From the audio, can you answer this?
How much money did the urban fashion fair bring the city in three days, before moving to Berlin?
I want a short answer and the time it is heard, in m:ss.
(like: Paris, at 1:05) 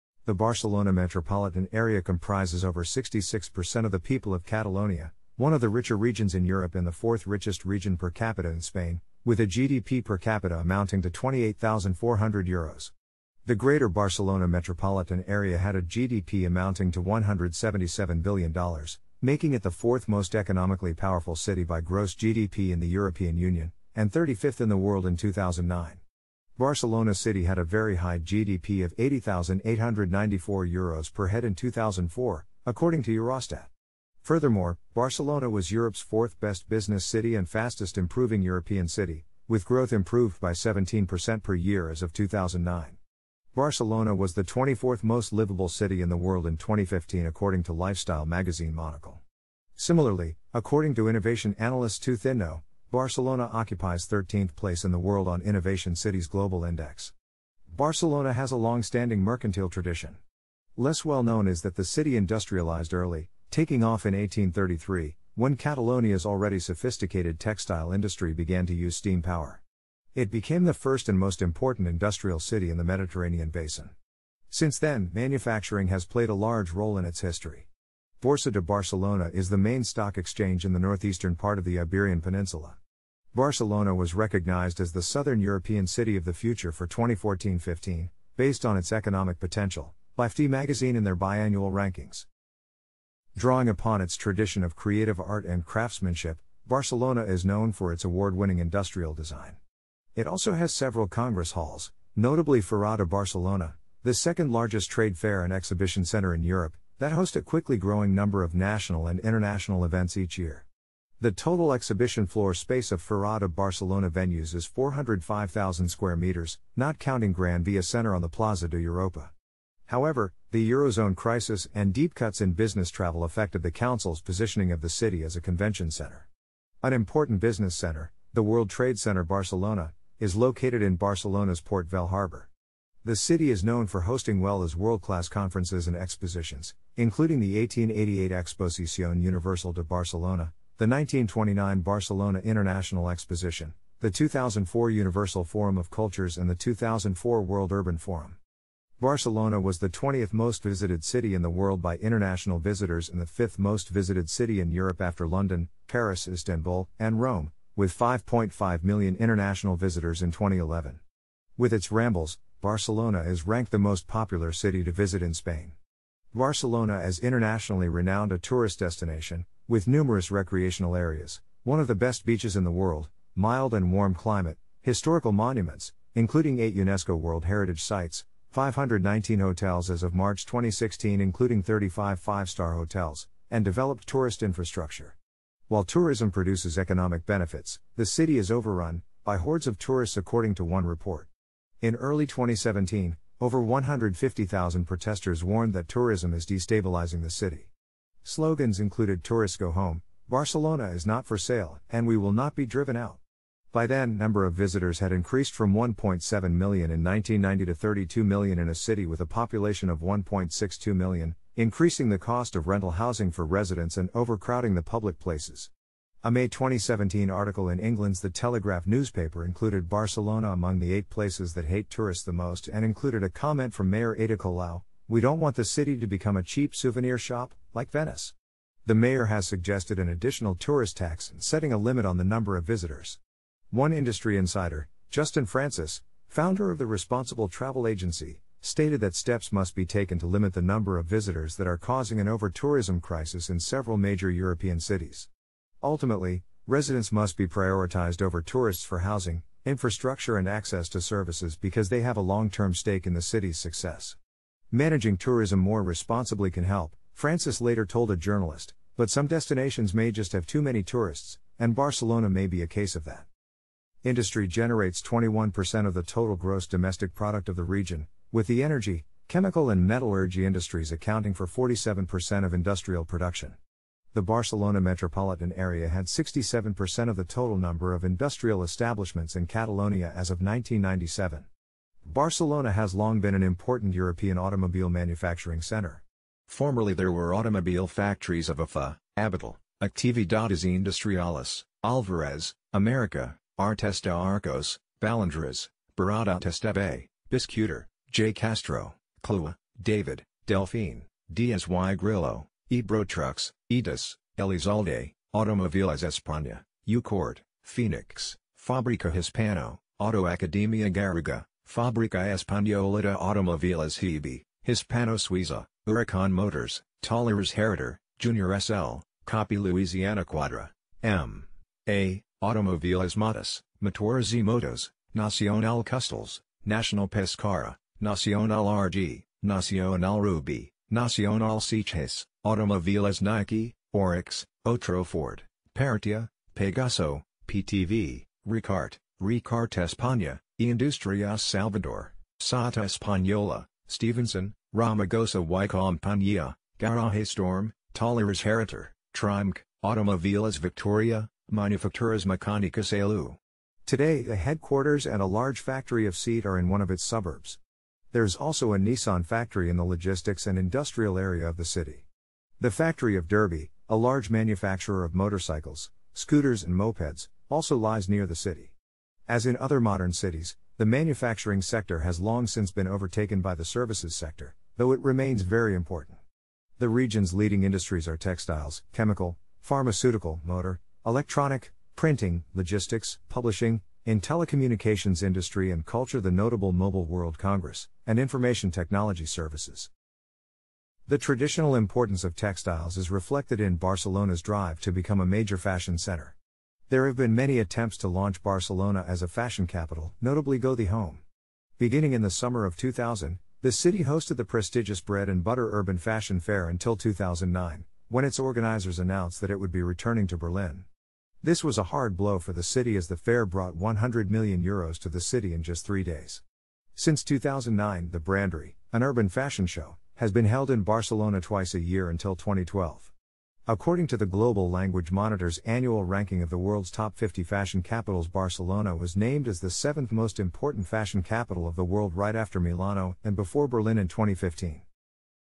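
100 million euros, at 6:53.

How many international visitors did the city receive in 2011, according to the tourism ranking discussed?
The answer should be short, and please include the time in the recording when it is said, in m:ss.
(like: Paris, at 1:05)
5.5 million, at 2:37.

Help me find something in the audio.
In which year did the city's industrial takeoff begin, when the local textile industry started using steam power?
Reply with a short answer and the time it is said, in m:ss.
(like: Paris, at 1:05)
1833, at 1:04.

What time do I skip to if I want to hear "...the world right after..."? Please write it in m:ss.
7:11.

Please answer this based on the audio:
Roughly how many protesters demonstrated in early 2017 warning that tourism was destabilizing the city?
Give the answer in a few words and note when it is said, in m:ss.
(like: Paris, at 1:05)
150,000, at 3:13.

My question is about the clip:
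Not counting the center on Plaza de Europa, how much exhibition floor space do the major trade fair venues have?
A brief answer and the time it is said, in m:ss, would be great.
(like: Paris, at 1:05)
405,000 square meters, at 1:54.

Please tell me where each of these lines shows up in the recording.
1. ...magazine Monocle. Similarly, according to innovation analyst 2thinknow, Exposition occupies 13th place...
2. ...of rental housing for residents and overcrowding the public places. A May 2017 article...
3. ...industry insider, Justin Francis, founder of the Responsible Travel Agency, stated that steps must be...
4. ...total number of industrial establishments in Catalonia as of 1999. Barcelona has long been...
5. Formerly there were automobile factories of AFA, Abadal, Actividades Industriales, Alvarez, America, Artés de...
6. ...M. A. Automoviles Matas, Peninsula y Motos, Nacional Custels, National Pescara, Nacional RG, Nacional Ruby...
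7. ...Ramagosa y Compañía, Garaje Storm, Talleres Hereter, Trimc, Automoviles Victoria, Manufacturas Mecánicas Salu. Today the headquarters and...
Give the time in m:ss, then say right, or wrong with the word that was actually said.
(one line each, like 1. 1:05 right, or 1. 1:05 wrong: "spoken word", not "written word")
1. 0:48 wrong: "Barcelona", not "Exposition"
2. 3:32 right
3. 3:53 right
4. 4:37 wrong: "1997", not "1999"
5. 4:46 right
6. 5:21 wrong: "Motores", not "Peninsula"
7. 5:44 right.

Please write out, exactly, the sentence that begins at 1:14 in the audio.
Since then, manufacturing has played a large role in its history.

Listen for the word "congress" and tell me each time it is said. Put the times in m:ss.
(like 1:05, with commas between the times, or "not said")
1:41, 6:27.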